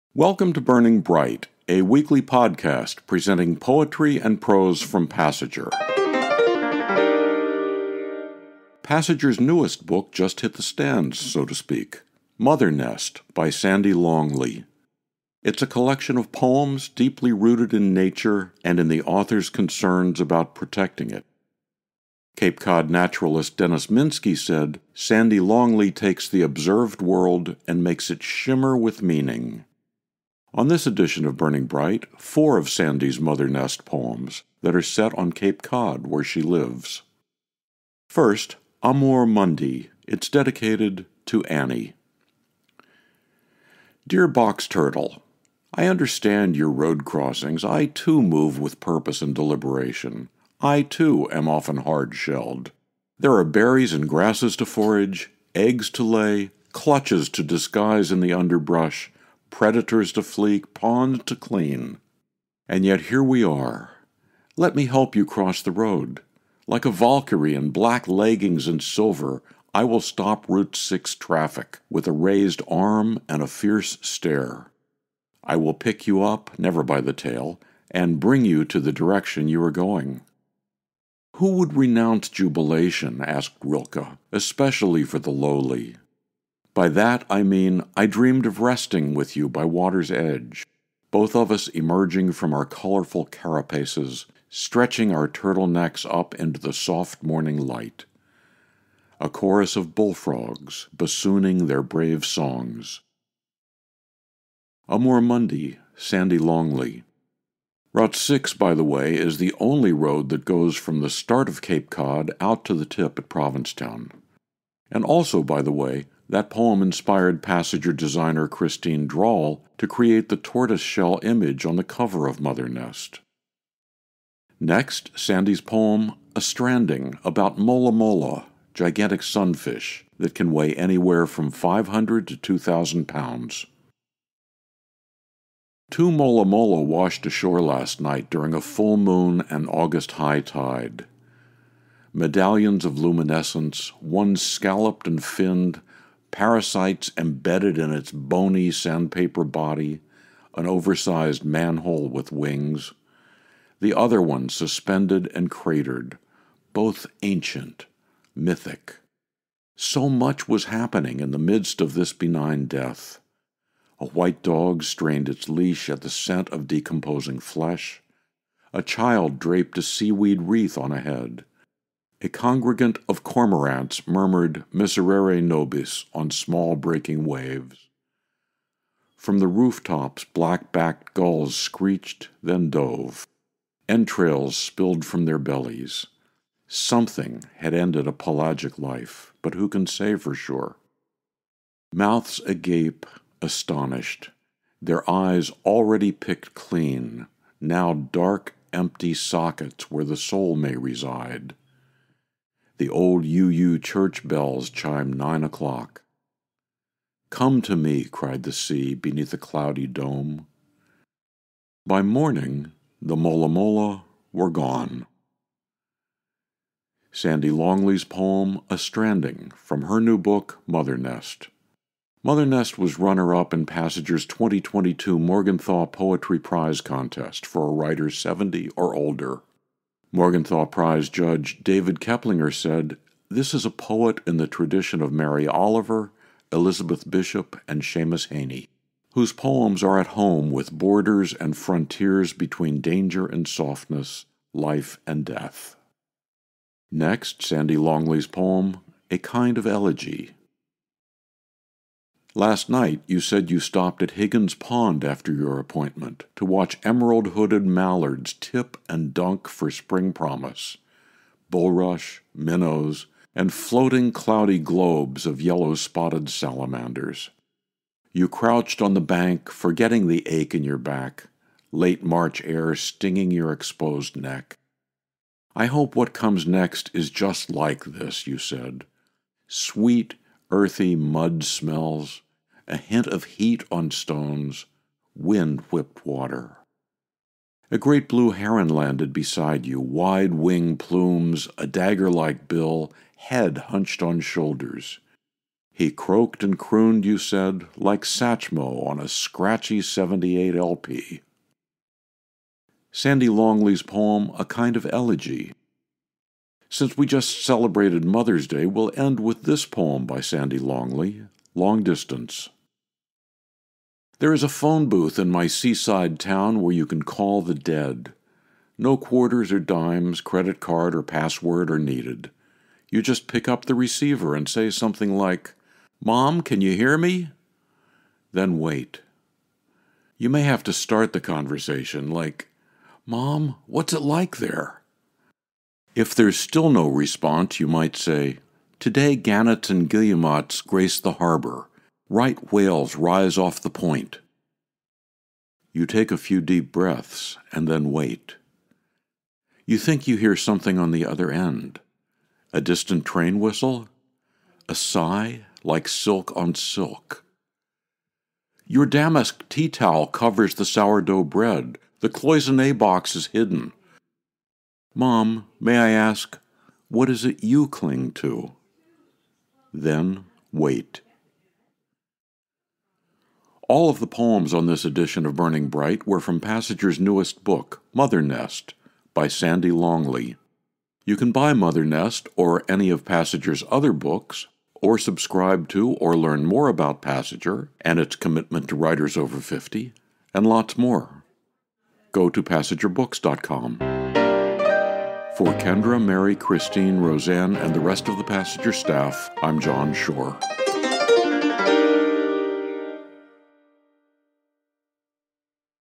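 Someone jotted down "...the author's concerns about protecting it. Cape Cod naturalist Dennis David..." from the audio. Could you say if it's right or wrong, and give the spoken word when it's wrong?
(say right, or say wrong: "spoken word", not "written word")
wrong: "Minsky", not "David".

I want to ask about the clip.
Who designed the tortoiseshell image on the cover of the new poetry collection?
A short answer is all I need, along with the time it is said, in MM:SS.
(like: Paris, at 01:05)
Christine Drawl, at 01:58.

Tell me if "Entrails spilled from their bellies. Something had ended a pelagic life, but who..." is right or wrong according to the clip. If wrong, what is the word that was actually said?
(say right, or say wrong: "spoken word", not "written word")
right.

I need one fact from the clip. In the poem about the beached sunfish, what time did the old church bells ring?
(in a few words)
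9 o'clock.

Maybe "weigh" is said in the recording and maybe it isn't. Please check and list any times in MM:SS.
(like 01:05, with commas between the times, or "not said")
02:10.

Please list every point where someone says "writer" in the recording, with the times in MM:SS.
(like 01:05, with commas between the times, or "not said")
03:47, 06:28.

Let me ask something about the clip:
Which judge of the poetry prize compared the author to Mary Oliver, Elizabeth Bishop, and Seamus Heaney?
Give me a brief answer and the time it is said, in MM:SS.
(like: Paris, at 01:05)
David Keplinger, at 03:51.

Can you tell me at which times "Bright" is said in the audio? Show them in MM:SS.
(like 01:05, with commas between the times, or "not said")
00:00, 00:31, 06:15.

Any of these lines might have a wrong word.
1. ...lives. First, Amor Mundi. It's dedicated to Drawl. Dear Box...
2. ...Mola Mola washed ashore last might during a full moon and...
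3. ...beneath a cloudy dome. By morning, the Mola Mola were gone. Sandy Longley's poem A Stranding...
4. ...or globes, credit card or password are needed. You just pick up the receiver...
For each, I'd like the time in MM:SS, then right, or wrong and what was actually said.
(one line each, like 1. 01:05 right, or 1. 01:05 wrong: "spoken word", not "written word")
1. 00:36 wrong: "Annie", not "Drawl"
2. 02:16 wrong: "night", not "might"
3. 03:28 right
4. 05:19 wrong: "dimes", not "globes".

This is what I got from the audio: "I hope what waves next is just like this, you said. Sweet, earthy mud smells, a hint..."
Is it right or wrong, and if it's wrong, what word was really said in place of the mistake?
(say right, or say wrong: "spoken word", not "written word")
wrong: "comes", not "waves".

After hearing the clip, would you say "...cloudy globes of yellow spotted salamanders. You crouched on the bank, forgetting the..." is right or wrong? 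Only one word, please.
right.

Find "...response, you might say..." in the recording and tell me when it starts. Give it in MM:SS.
05:36.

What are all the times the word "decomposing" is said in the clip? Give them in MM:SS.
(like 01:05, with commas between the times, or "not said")
02:46.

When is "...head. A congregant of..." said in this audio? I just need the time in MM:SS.
02:51.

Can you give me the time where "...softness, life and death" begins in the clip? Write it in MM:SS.
04:03.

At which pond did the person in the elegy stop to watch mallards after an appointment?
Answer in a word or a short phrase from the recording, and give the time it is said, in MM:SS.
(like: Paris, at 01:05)
Higgins Pond, at 04:14.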